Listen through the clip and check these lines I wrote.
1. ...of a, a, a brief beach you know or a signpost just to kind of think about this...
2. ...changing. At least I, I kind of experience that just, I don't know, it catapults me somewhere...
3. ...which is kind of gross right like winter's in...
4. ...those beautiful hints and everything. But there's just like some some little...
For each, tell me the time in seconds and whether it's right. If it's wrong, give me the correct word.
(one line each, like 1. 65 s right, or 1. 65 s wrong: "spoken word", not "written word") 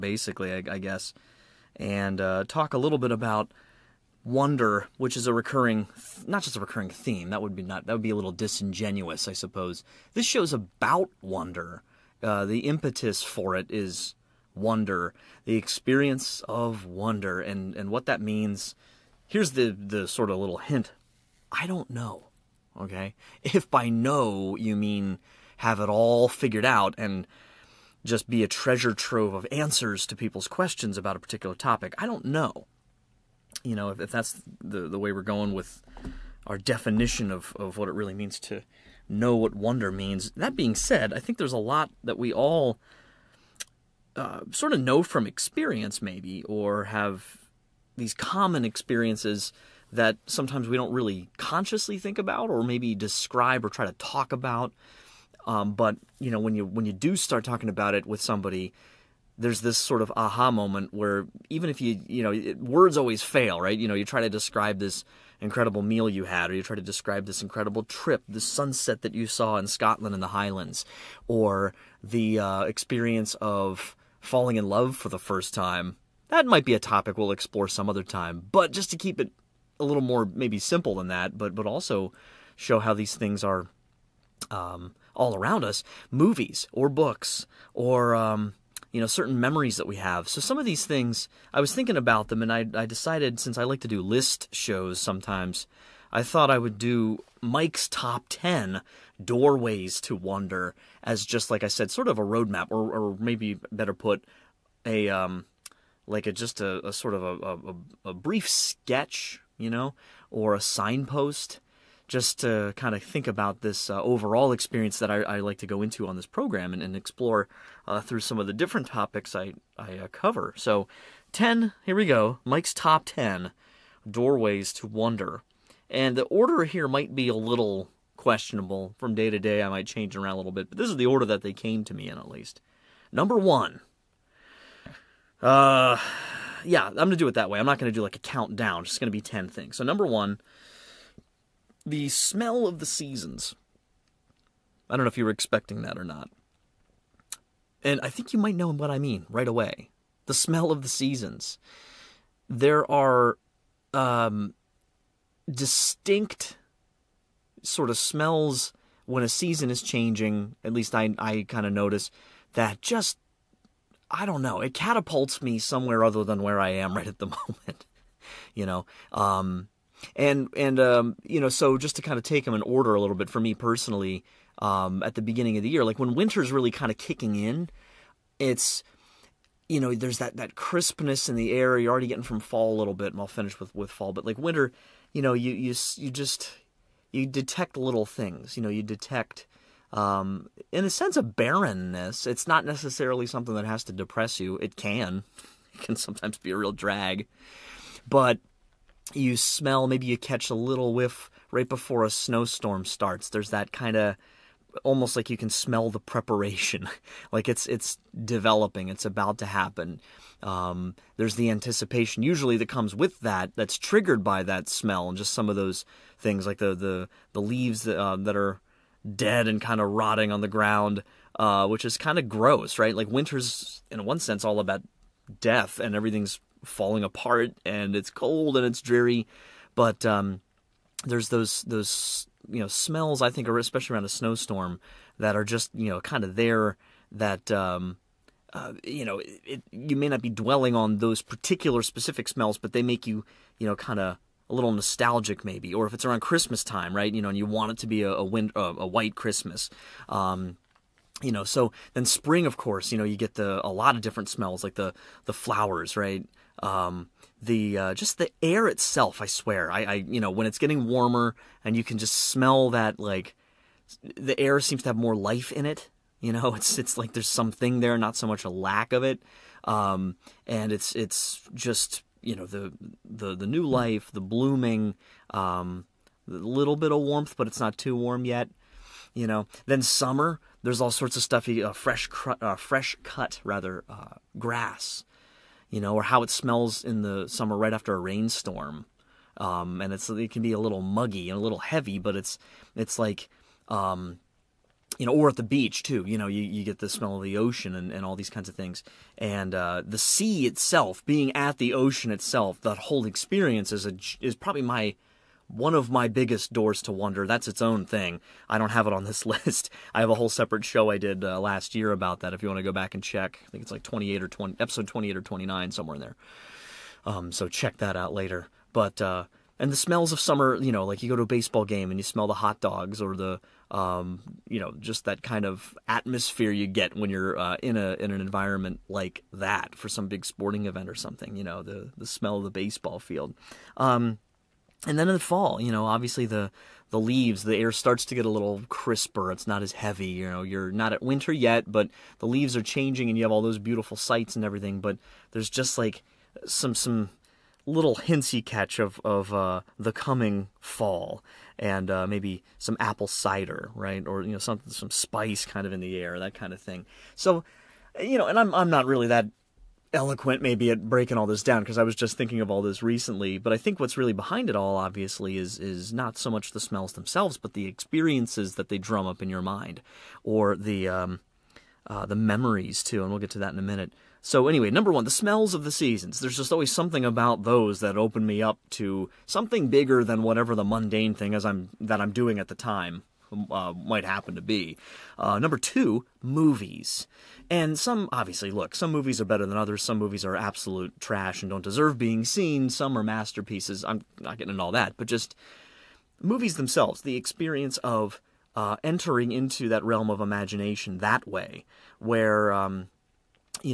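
1. 107 s wrong: "sketch", not "beach"
2. 159 s wrong: "notice", not "experience"
3. 221 s right
4. 343 s wrong: "sights", not "hints".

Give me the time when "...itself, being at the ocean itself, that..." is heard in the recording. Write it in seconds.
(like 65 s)
300 s.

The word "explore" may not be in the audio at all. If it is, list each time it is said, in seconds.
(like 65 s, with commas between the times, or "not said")
77 s, 116 s.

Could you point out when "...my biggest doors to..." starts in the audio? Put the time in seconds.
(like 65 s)
305 s.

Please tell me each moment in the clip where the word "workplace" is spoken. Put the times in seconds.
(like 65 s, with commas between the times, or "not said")
not said.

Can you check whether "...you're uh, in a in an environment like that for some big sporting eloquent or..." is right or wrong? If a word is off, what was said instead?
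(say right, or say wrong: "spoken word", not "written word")
wrong: "event", not "eloquent".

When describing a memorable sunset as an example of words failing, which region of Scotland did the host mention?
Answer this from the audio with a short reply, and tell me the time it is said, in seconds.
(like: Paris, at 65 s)
The Highlands, at 70 s.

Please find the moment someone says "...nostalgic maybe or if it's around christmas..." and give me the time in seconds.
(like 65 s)
244 s.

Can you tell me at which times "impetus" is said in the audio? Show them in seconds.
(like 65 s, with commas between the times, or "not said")
12 s.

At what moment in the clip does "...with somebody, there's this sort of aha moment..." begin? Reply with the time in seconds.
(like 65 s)
58 s.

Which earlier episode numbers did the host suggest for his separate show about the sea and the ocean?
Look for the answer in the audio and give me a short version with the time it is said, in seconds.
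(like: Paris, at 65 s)
28 or 29, at 314 s.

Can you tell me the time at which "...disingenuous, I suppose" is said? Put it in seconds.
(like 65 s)
8 s.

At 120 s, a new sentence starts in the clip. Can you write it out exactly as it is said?
So, 10, here we go Mike's top 10 doorways to wonder.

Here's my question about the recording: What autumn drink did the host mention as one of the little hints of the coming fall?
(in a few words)
Apple cider.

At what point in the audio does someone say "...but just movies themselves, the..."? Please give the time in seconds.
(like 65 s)
394 s.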